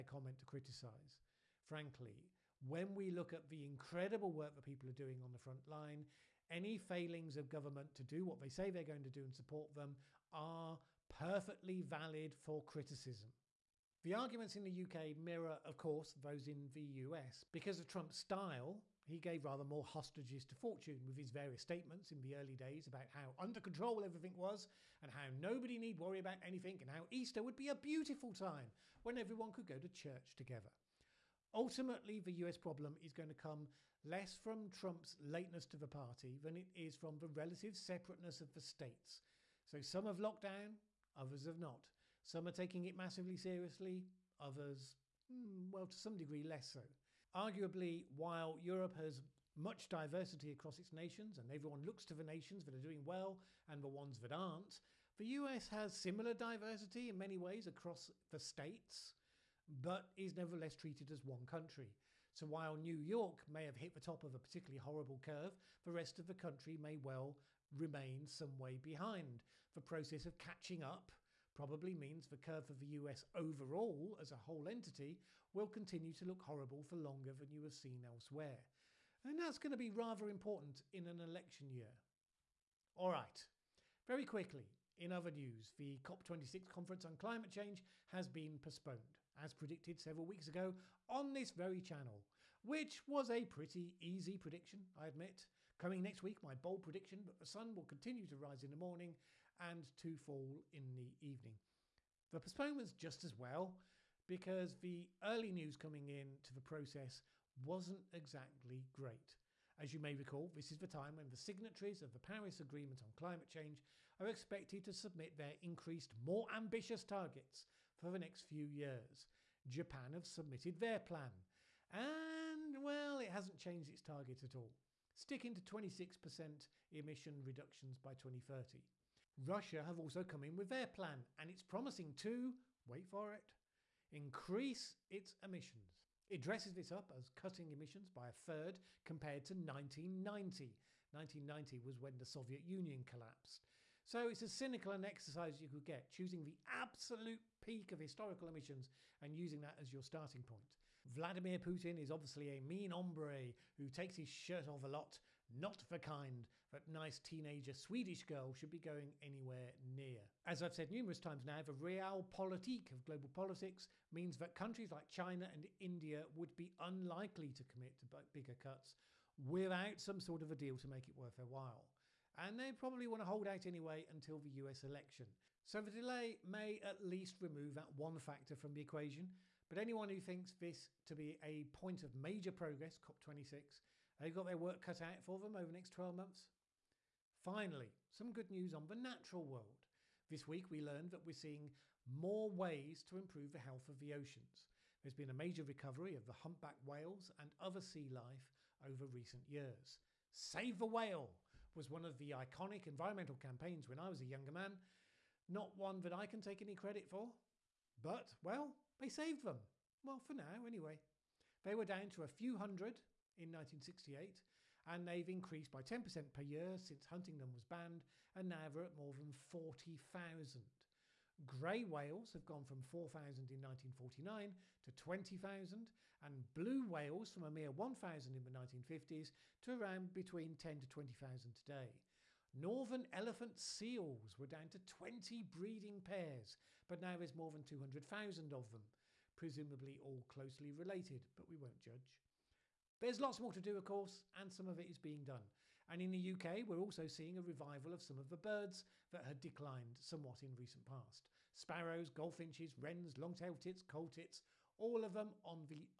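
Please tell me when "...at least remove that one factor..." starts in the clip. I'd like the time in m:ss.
2:56.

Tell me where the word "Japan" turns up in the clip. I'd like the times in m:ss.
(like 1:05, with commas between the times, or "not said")
1:59.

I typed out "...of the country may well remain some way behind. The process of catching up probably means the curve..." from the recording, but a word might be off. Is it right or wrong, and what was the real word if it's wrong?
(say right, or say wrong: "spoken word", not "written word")
right.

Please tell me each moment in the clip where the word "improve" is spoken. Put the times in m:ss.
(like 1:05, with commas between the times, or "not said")
3:13.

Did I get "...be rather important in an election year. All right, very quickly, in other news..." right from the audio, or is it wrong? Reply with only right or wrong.
right.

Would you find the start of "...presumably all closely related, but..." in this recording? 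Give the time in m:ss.
3:59.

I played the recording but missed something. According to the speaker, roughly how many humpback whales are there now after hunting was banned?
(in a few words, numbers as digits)
more than 40,000.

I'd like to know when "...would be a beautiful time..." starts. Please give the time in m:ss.
0:27.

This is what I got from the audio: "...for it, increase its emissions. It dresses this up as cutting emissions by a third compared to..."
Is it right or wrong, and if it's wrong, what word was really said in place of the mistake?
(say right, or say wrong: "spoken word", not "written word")
right.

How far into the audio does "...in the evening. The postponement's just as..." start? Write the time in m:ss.
1:40.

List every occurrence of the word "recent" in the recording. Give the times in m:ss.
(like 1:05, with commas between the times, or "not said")
3:19, 4:10.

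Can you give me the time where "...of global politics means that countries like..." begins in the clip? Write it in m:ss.
2:42.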